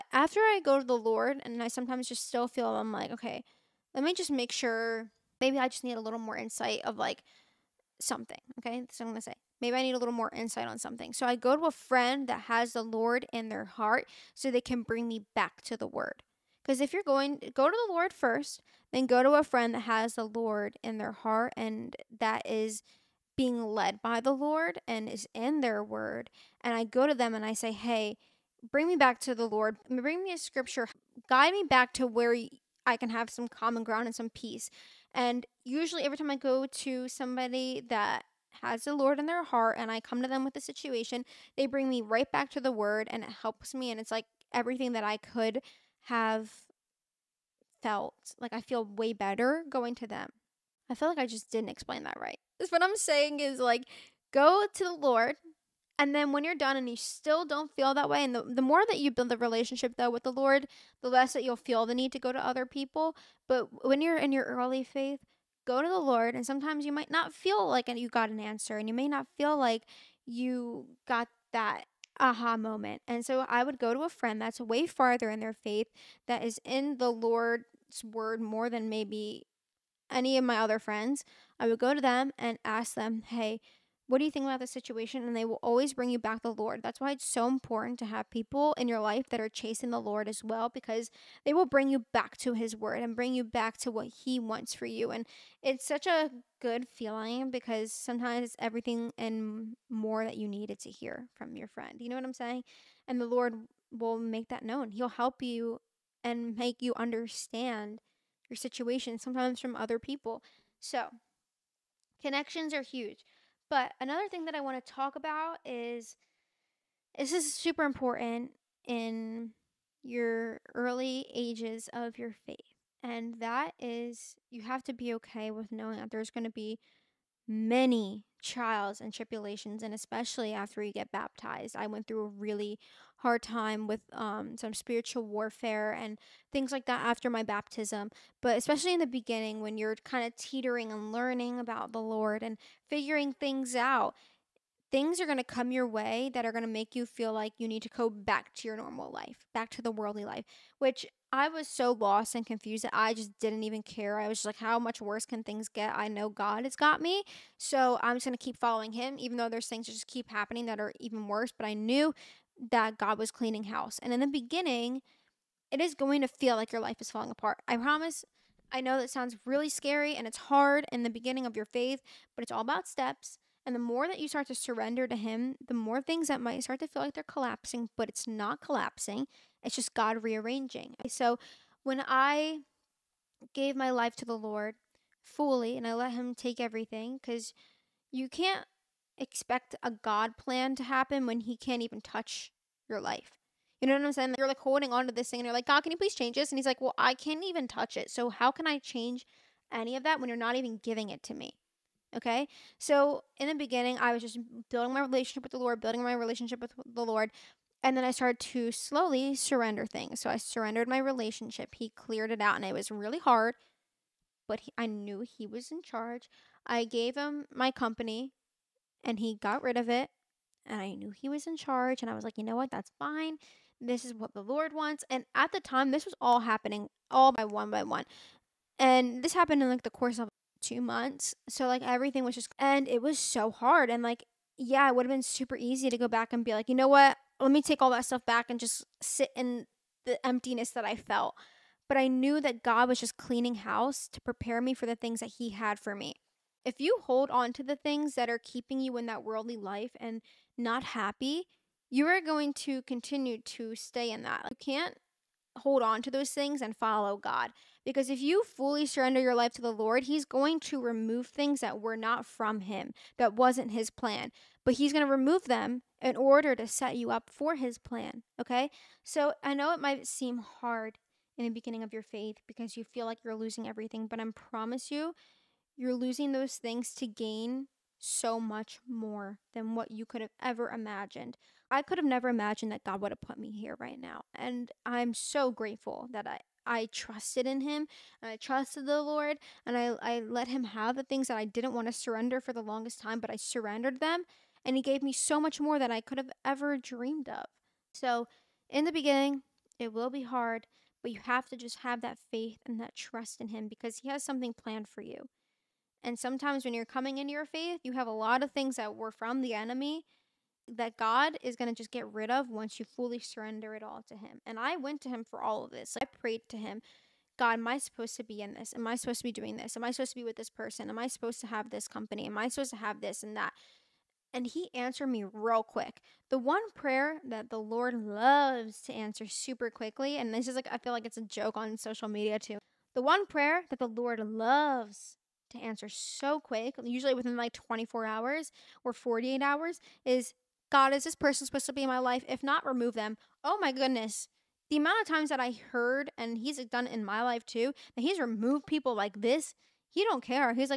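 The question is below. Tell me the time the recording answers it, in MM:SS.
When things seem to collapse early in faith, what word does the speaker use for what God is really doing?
03:00.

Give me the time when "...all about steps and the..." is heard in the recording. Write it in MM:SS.
02:52.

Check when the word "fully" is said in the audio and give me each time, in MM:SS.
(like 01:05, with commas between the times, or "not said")
03:05, 04:18, 05:12.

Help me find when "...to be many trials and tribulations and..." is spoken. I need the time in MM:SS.
02:06.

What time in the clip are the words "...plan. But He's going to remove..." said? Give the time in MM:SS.
04:23.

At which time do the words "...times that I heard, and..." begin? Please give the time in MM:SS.
05:45.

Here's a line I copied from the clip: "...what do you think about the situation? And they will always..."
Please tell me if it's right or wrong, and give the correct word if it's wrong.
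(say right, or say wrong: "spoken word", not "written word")
right.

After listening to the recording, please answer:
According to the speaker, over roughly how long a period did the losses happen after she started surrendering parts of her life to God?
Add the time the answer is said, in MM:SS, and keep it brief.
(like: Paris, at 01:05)
2 months, at 03:50.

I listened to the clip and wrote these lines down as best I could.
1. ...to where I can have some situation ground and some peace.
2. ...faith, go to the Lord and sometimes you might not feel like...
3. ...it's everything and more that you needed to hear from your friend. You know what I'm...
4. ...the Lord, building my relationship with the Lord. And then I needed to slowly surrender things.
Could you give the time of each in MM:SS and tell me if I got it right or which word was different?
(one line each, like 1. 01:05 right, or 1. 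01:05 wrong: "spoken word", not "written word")
1. 00:31 wrong: "common", not "situation"
2. 01:04 right
3. 01:38 right
4. 03:25 wrong: "started", not "needed".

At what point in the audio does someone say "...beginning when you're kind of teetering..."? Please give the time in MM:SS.
02:19.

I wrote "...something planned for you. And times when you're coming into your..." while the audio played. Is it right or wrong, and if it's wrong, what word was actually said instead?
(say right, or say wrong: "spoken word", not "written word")
wrong: "sometimes", not "times".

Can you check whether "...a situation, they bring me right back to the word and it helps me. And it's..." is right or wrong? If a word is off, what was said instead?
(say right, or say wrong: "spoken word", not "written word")
right.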